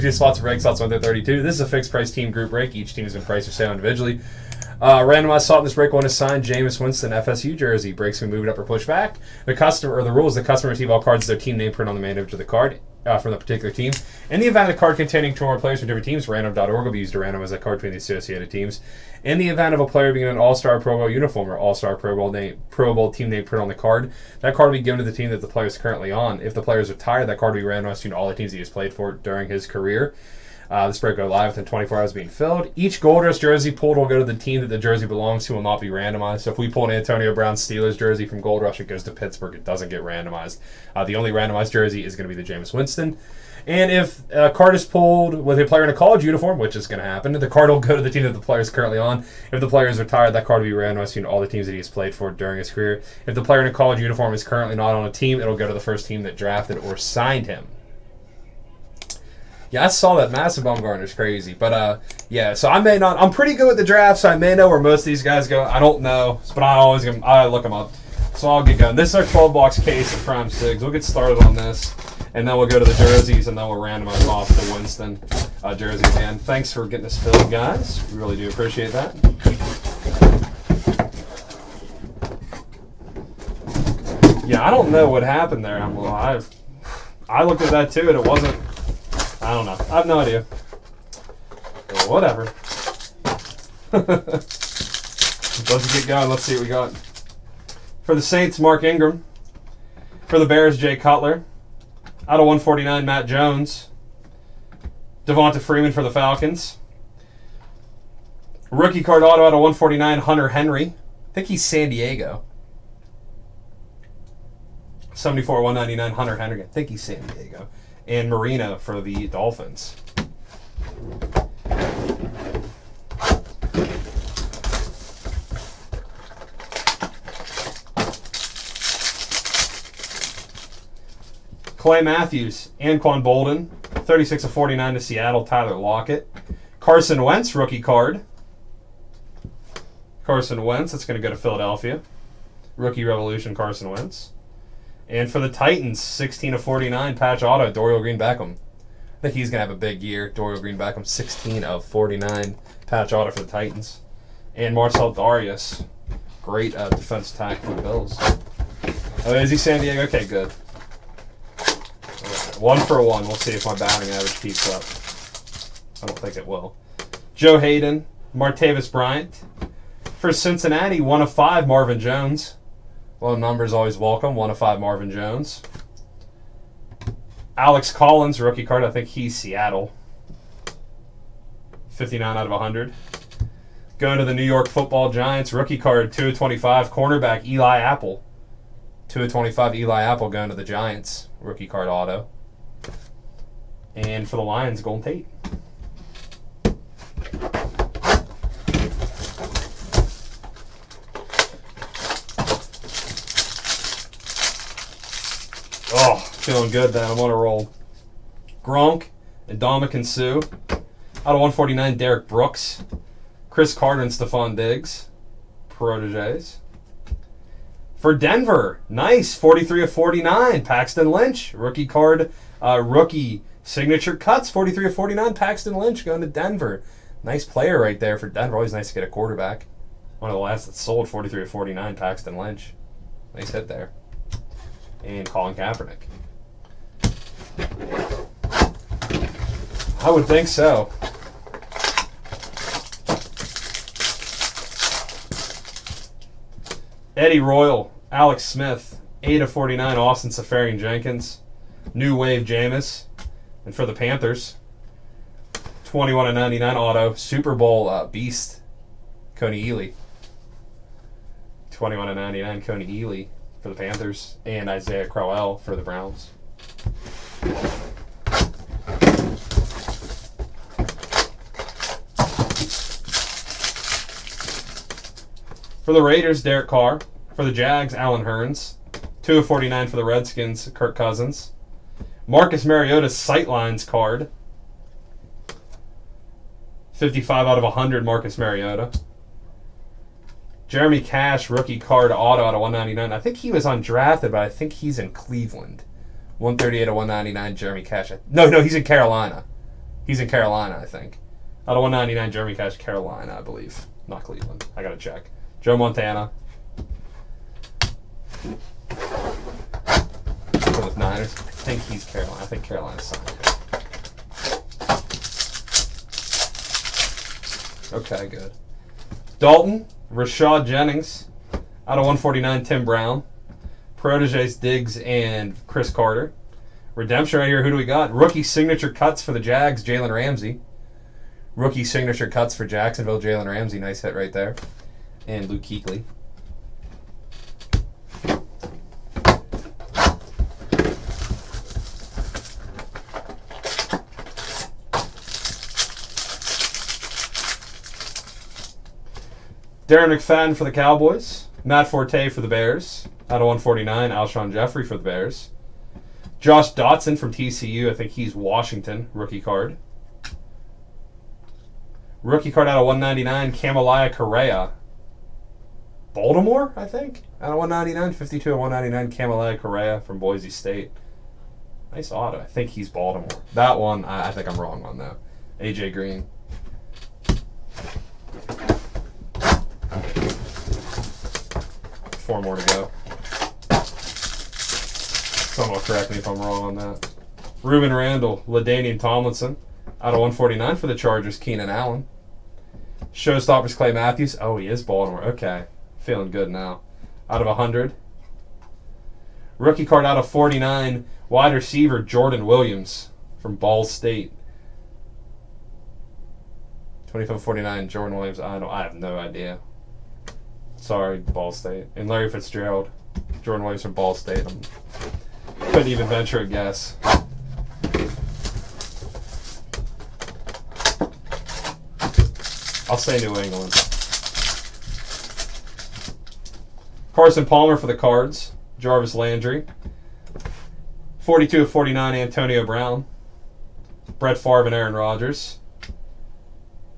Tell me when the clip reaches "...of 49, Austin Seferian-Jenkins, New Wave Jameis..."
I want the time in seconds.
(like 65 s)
249 s.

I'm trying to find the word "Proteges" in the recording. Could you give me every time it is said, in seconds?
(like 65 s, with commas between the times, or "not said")
215 s, 324 s.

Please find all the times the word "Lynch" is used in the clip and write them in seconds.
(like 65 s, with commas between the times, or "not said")
221 s, 225 s, 232 s.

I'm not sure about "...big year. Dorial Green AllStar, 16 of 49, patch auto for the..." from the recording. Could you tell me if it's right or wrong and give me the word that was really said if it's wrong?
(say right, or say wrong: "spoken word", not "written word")
wrong: "Beckham", not "AllStar".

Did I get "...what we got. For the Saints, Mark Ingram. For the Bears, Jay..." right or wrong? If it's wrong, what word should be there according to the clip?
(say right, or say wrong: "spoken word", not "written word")
right.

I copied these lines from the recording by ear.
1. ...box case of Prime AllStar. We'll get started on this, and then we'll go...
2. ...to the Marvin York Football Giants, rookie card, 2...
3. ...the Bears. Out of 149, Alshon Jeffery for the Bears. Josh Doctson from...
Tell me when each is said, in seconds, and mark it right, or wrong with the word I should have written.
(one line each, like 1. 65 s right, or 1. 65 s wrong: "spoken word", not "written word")
1. 69 s wrong: "Sigs", not "AllStar"
2. 184 s wrong: "New", not "Marvin"
3. 352 s right.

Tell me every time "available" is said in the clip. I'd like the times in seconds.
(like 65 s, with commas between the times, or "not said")
not said.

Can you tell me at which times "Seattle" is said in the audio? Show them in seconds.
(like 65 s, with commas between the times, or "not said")
135 s, 179 s.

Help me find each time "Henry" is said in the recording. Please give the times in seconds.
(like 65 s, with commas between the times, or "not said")
110 s, 116 s.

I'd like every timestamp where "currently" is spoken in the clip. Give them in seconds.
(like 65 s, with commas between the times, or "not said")
25 s, 48 s, 54 s.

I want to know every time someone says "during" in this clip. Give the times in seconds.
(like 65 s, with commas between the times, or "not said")
29 s, 52 s.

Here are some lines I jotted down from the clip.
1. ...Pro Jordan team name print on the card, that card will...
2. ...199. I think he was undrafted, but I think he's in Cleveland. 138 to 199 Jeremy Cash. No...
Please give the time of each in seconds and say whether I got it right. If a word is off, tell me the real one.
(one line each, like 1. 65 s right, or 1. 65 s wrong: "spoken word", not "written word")
1. 22 s wrong: "Bowl", not "Jordan"
2. 292 s right.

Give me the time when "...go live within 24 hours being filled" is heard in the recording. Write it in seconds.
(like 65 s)
31 s.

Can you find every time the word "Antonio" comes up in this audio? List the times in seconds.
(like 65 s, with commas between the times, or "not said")
36 s, 432 s.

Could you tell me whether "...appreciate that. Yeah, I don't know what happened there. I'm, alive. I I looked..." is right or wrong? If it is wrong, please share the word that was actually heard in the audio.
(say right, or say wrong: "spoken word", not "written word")
right.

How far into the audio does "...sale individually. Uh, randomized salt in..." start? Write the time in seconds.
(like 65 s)
3 s.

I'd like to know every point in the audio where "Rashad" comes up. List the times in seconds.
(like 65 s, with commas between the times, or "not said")
320 s.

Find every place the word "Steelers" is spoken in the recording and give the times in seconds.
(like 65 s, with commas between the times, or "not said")
37 s.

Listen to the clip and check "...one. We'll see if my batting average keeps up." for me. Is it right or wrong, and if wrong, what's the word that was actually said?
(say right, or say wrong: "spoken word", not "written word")
right.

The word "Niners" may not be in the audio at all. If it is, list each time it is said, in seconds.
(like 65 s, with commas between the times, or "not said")
310 s.